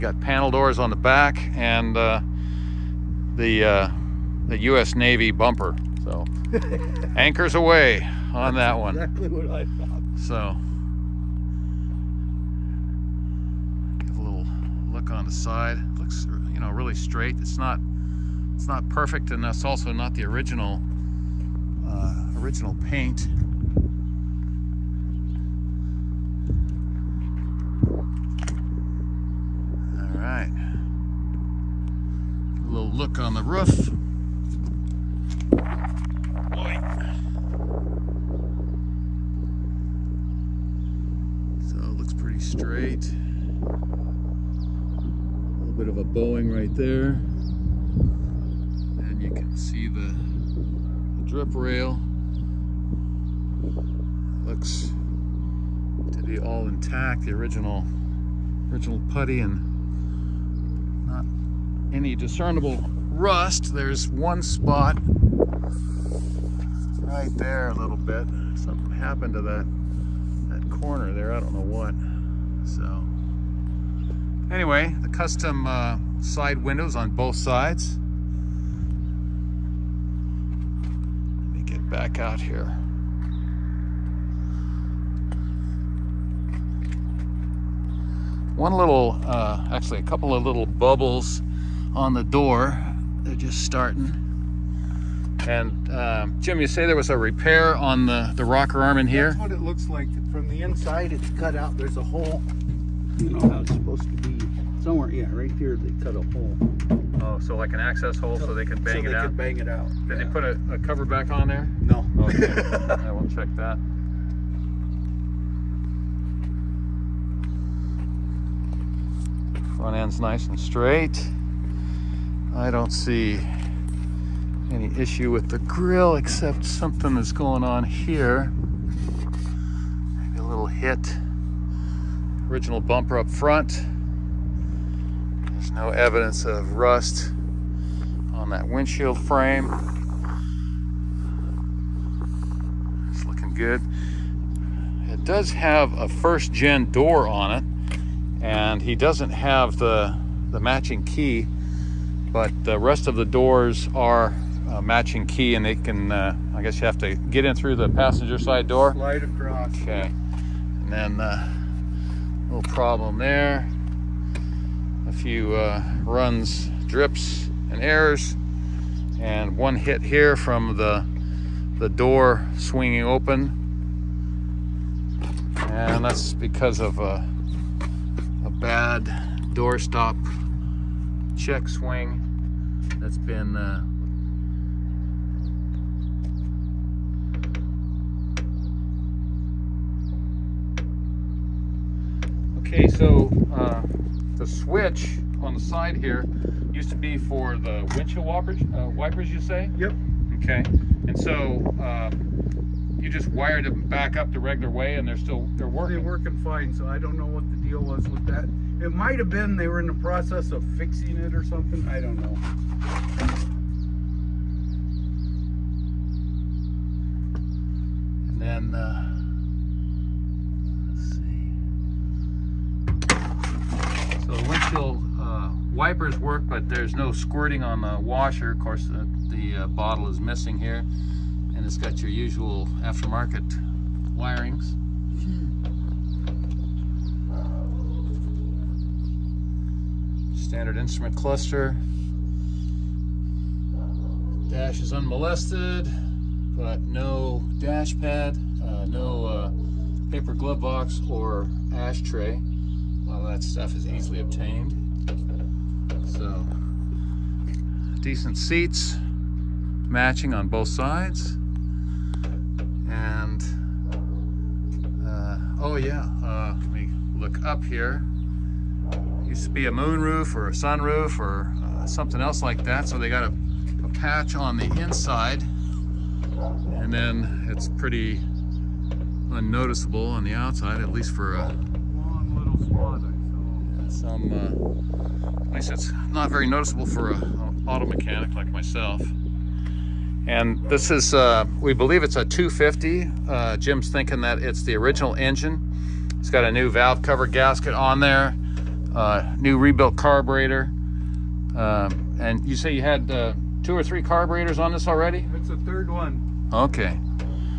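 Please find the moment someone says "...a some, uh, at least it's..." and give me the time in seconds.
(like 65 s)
281 s.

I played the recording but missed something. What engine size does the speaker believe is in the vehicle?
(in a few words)
250.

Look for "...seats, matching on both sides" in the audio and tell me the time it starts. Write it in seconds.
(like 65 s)
258 s.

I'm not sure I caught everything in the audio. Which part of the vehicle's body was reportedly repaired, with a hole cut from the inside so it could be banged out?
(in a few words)
rocker arm.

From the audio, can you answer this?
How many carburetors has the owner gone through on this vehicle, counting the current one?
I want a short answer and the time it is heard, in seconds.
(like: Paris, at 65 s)
3, at 305 s.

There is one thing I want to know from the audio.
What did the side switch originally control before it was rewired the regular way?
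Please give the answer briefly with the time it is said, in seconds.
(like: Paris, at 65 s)
windshield wipers, at 197 s.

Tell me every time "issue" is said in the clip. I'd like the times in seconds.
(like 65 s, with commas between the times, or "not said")
124 s.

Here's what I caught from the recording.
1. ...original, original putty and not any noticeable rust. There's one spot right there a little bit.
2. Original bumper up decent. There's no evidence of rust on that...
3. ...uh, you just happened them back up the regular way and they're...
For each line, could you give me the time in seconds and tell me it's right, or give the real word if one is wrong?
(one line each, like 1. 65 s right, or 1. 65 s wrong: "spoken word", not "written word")
1. 57 s wrong: "discernible", not "noticeable"
2. 132 s wrong: "front", not "decent"
3. 201 s wrong: "wired", not "happened".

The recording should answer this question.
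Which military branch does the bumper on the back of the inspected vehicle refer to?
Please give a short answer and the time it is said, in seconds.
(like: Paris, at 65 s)
U.S. Navy, at 4 s.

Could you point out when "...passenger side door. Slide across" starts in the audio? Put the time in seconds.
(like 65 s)
157 s.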